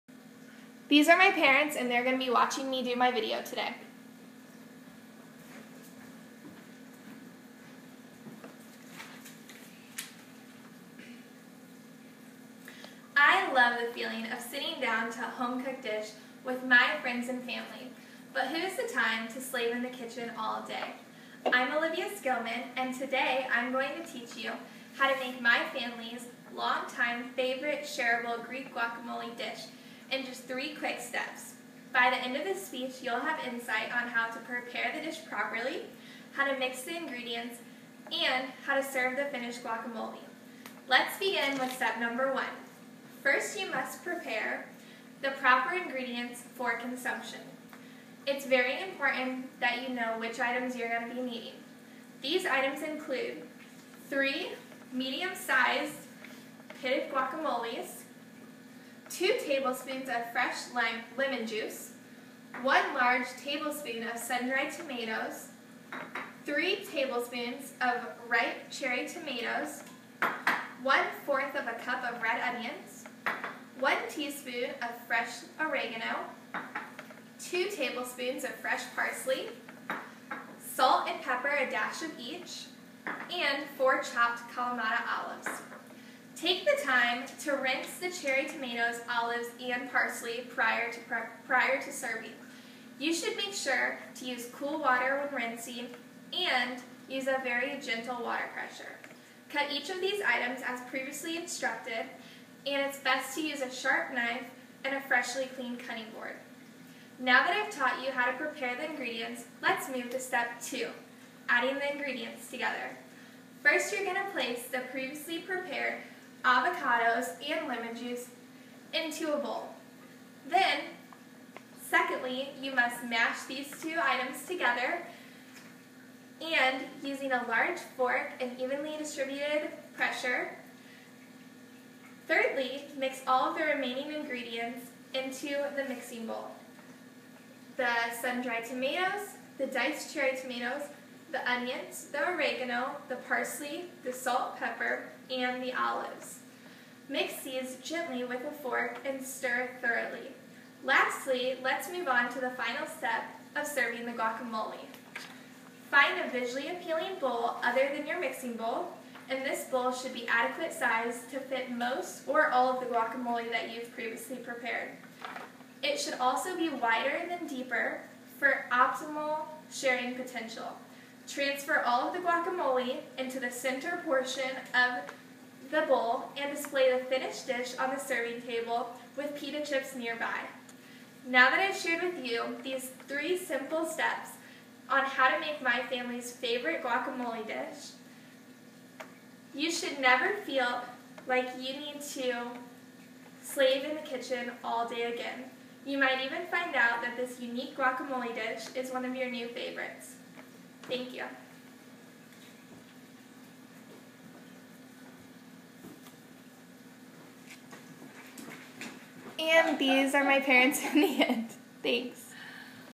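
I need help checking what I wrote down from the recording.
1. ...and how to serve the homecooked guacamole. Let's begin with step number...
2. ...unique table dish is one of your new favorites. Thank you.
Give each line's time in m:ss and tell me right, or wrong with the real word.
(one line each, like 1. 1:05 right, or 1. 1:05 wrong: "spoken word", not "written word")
1. 0:38 wrong: "finished", not "homecooked"
2. 3:17 wrong: "guacamole", not "table".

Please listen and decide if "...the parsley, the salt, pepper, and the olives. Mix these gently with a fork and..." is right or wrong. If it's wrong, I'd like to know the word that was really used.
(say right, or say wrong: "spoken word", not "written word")
right.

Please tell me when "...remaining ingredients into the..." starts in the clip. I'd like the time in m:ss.
2:13.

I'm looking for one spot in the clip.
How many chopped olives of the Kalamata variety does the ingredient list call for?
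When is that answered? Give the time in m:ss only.
1:23.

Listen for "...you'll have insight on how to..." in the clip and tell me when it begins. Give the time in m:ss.
0:33.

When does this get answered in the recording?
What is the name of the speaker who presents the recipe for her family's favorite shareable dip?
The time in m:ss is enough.
0:21.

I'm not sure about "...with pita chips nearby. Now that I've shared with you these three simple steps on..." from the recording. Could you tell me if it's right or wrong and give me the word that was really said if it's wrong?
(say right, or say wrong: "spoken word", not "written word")
right.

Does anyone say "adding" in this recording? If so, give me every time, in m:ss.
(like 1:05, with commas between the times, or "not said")
1:51.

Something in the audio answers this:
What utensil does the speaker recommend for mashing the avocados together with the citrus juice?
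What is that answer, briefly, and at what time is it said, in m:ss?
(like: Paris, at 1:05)
a large fork, at 2:07.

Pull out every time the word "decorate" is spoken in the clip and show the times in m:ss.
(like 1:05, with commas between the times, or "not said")
not said.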